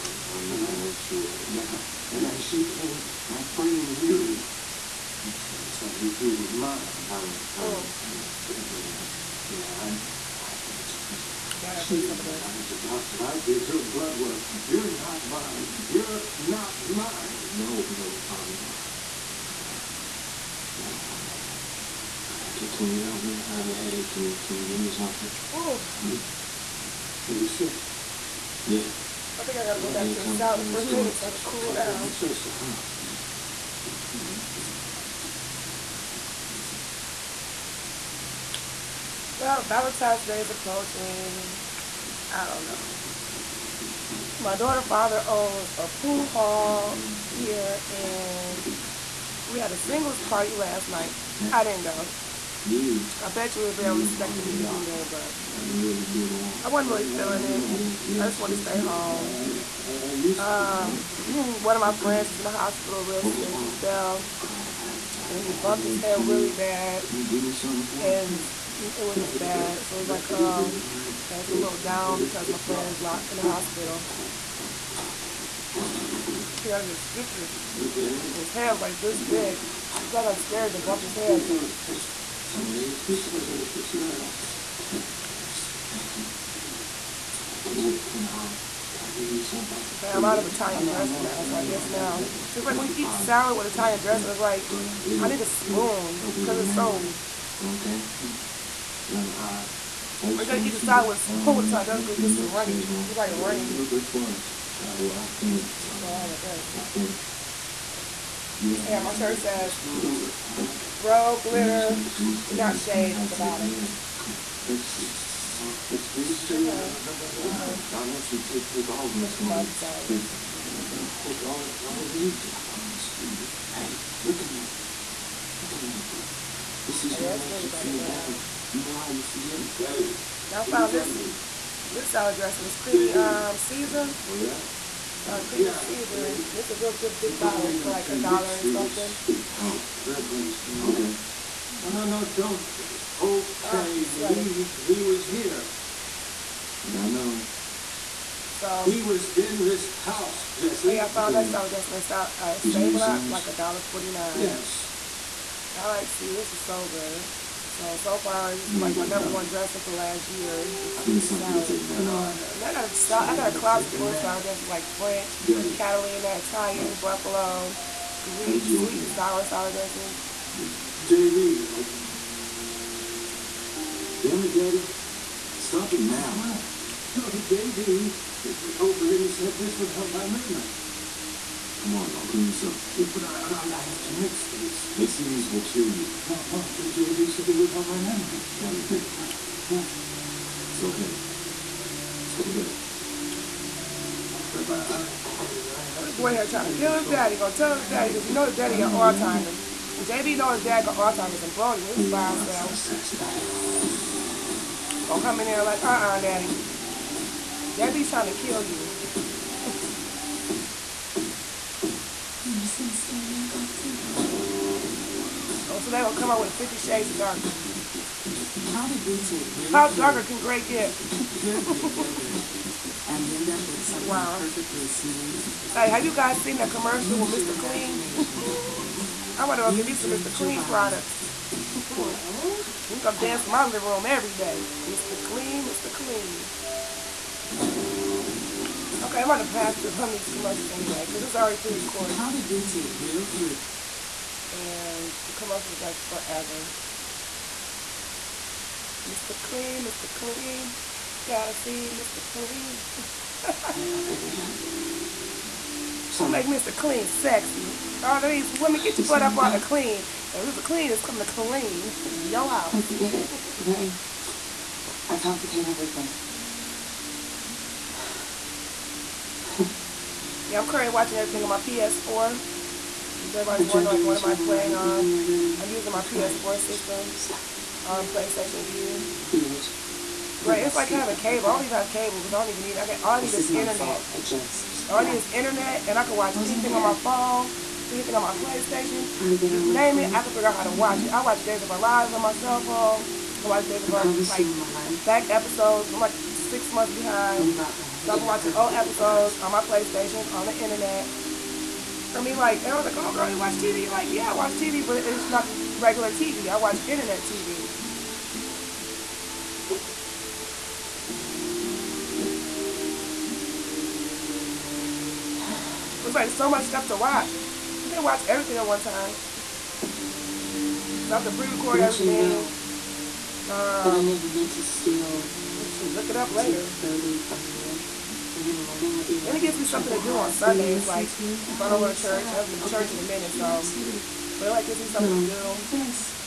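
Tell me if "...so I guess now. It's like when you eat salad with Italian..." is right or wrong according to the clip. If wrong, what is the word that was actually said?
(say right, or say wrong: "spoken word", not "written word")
right.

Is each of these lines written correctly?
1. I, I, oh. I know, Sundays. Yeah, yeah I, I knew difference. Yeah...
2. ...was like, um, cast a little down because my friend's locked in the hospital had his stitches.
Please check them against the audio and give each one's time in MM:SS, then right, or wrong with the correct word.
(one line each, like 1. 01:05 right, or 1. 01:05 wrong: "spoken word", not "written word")
1. 00:07 wrong: "Dad", not "Sundays"
2. 01:09 right.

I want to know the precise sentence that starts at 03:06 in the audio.
No, no, JB said they would help my memory.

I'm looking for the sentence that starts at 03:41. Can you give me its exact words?
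Pure Greek yogurt and end up with something wow.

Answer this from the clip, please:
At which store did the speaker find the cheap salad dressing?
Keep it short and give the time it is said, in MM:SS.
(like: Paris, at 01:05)
Save a Lot, at 02:32.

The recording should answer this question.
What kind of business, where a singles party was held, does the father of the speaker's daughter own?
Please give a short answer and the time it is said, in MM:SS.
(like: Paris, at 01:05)
pool hall, at 00:45.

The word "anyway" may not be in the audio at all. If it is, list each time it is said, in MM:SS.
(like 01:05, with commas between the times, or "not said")
04:00.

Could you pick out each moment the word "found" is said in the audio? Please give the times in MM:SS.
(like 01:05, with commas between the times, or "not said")
02:10, 02:31.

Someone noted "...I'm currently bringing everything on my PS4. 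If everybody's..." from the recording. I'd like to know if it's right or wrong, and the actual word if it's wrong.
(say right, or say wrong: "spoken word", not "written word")
wrong: "watching", not "bringing".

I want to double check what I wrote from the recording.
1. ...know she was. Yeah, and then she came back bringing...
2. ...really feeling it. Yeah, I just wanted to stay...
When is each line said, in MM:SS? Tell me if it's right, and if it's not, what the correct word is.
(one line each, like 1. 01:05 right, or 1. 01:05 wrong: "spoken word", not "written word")
1. 00:00 right
2. 00:56 right.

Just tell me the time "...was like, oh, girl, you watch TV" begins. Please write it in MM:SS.
05:02.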